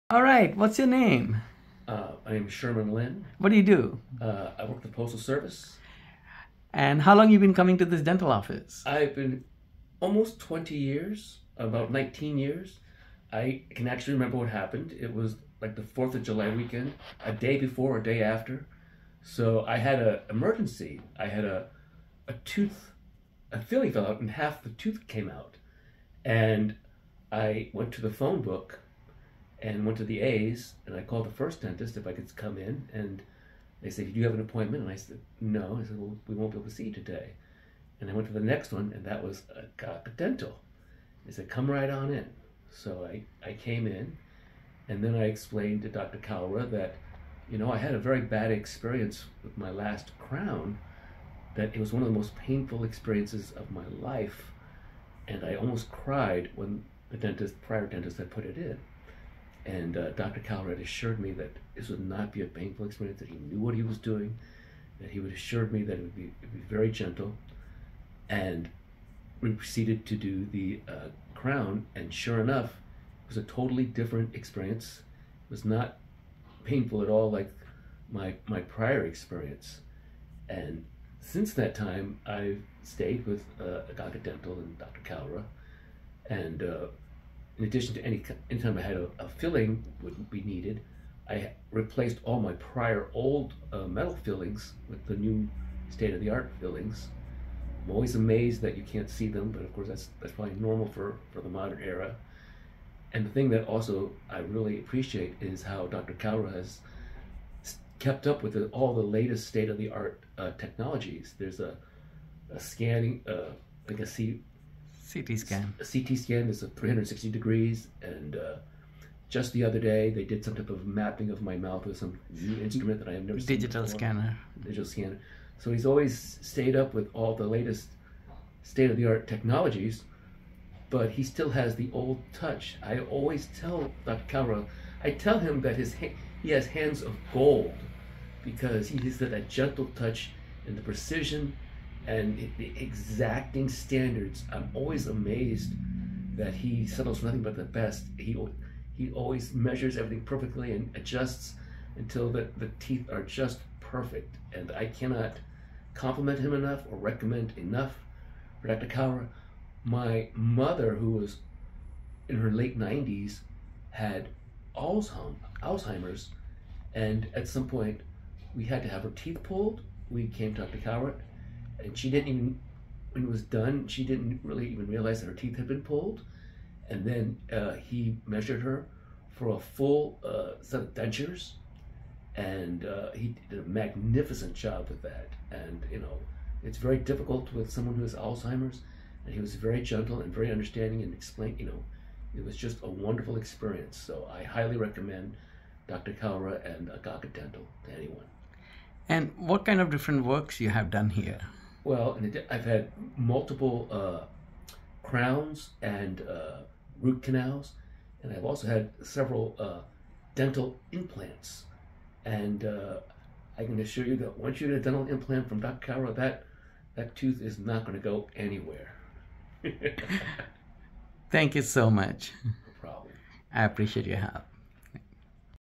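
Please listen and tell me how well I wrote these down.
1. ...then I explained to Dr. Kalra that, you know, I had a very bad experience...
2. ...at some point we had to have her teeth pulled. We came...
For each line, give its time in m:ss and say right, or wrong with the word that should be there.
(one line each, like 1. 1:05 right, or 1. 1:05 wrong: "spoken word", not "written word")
1. 0:45 right
2. 2:47 right.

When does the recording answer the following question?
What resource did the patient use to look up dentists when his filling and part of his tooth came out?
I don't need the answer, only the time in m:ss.
0:28.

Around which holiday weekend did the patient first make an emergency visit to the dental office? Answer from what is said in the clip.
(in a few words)
4th of July.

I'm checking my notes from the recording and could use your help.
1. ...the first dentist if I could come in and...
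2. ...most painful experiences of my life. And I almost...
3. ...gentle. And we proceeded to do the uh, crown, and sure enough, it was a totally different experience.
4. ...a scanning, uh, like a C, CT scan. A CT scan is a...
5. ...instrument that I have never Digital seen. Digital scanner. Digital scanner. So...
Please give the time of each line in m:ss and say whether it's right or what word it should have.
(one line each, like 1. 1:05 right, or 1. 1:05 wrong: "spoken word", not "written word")
1. 0:31 right
2. 0:52 right
3. 1:06 right
4. 1:52 right
5. 2:02 right.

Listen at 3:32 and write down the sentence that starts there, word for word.
And uh, I can assure you that once you get a dental implant from Dr.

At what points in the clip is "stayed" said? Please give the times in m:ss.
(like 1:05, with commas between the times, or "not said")
1:22, 2:06.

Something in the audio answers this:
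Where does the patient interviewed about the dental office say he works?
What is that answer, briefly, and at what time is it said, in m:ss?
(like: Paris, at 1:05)
Postal Service, at 0:04.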